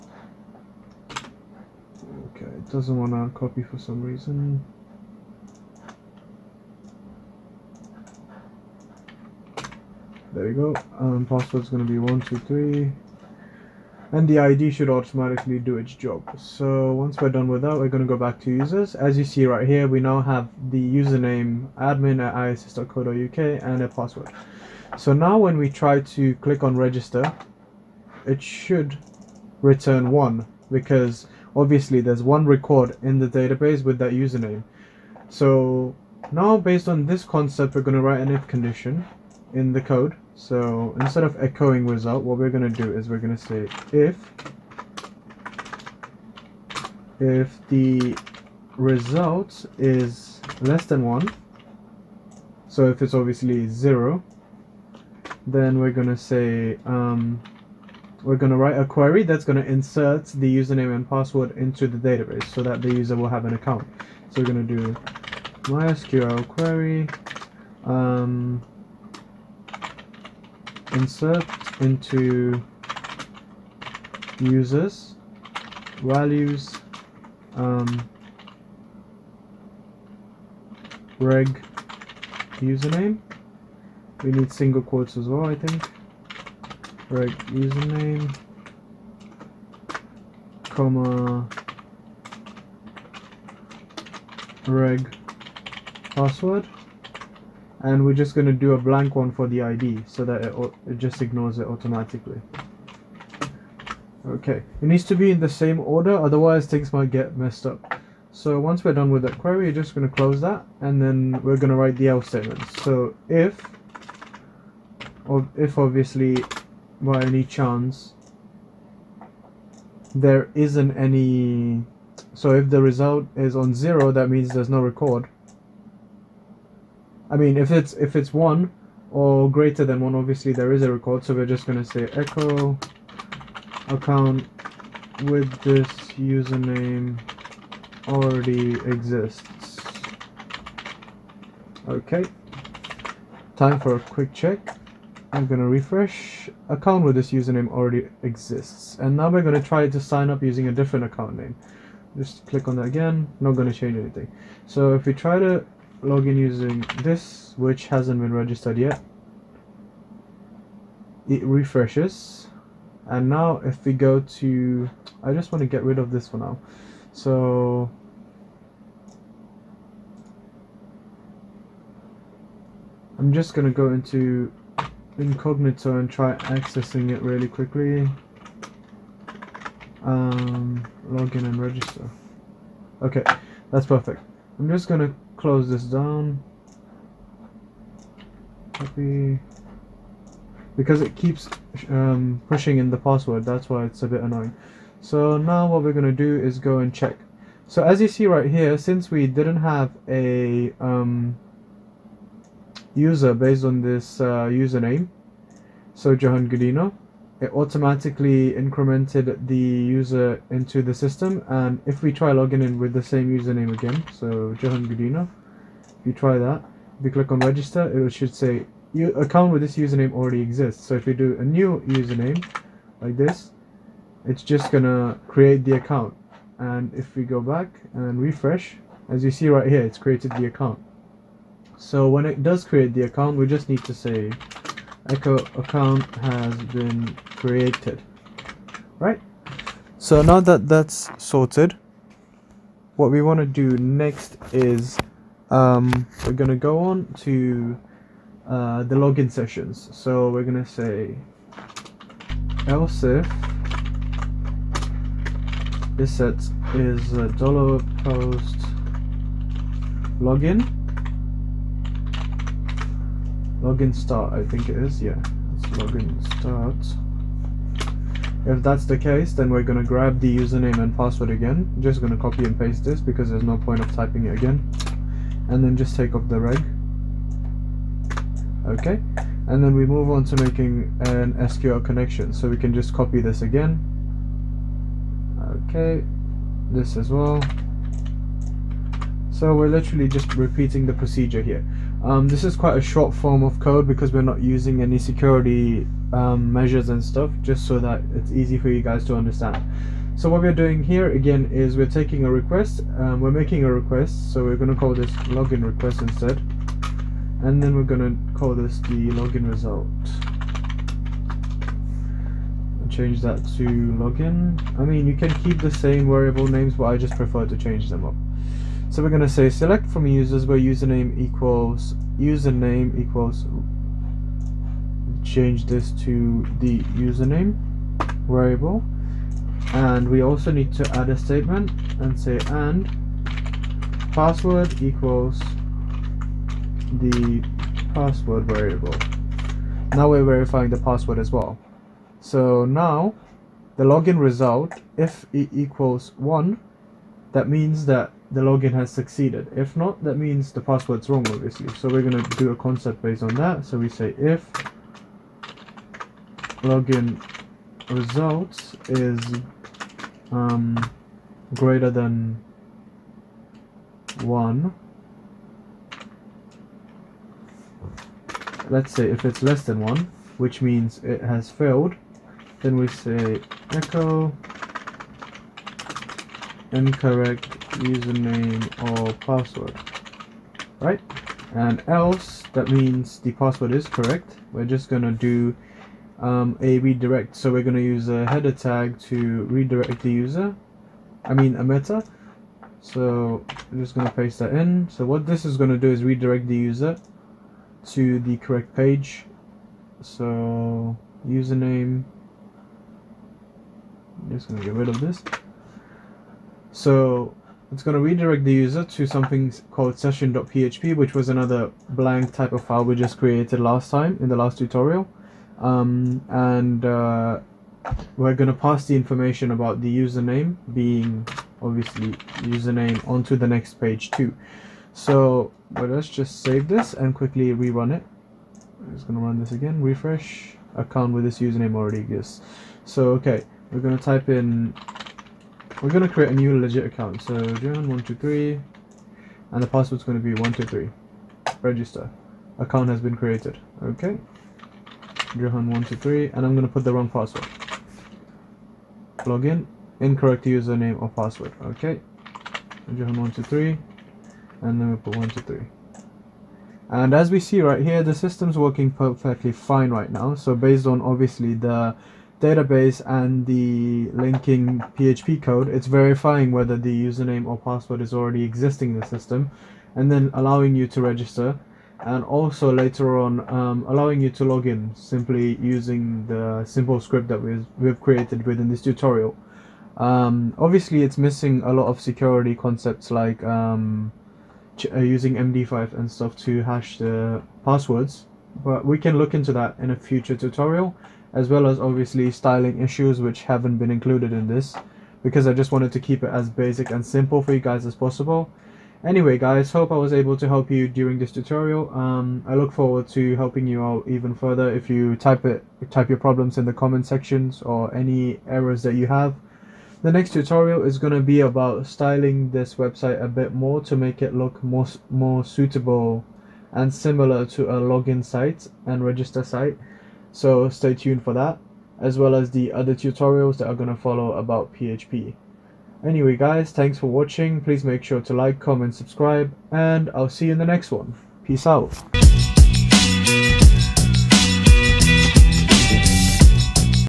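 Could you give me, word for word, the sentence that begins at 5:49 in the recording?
If not, that means the password's wrong, obviously.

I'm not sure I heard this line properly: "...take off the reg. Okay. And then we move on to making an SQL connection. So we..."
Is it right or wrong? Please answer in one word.
right.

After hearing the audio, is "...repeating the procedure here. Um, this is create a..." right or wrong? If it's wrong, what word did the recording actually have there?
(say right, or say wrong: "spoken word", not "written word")
wrong: "quite", not "create".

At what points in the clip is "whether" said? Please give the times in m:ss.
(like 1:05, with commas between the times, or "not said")
7:46.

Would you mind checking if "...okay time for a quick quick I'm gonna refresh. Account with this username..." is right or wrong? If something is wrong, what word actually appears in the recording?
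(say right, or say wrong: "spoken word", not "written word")
wrong: "check", not "quick".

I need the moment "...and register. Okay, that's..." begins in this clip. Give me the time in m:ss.
3:01.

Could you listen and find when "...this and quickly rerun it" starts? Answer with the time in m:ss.
7:06.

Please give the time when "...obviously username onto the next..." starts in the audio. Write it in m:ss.
7:01.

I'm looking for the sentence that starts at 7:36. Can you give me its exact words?
And as we see right here, the system's working perfectly fine right now.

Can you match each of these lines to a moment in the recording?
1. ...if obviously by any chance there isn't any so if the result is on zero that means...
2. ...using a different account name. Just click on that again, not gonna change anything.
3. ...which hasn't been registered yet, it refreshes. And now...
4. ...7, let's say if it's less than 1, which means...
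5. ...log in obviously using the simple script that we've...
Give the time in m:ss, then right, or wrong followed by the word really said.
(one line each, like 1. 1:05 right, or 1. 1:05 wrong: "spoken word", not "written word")
1. 1:55 right
2. 2:30 right
3. 2:37 right
4. 6:04 wrong: "1", not "7"
5. 7:54 wrong: "simply", not "obviously".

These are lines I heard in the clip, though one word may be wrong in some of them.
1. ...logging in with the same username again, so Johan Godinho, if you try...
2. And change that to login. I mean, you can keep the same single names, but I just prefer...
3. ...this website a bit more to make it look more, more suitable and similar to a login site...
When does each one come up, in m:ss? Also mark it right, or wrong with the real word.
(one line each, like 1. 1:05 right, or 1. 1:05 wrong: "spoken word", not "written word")
1. 3:32 right
2. 5:12 wrong: "variable", not "single"
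3. 8:32 right.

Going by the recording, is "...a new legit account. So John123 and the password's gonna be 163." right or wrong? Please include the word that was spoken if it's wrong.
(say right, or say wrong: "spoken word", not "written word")
wrong: "123", not "163".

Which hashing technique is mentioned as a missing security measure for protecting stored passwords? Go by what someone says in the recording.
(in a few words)
MD5.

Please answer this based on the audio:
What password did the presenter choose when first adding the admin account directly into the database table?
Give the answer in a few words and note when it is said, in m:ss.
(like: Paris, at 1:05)
123, at 0:11.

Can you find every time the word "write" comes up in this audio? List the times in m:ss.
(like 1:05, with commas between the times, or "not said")
0:38, 0:58, 1:51.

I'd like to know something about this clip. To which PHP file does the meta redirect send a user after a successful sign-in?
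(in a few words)
session.php.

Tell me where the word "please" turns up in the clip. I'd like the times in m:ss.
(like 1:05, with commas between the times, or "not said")
8:47.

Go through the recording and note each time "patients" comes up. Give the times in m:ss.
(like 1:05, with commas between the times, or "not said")
not said.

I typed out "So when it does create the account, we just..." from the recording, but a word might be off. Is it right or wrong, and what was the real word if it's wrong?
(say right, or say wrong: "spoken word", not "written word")
right.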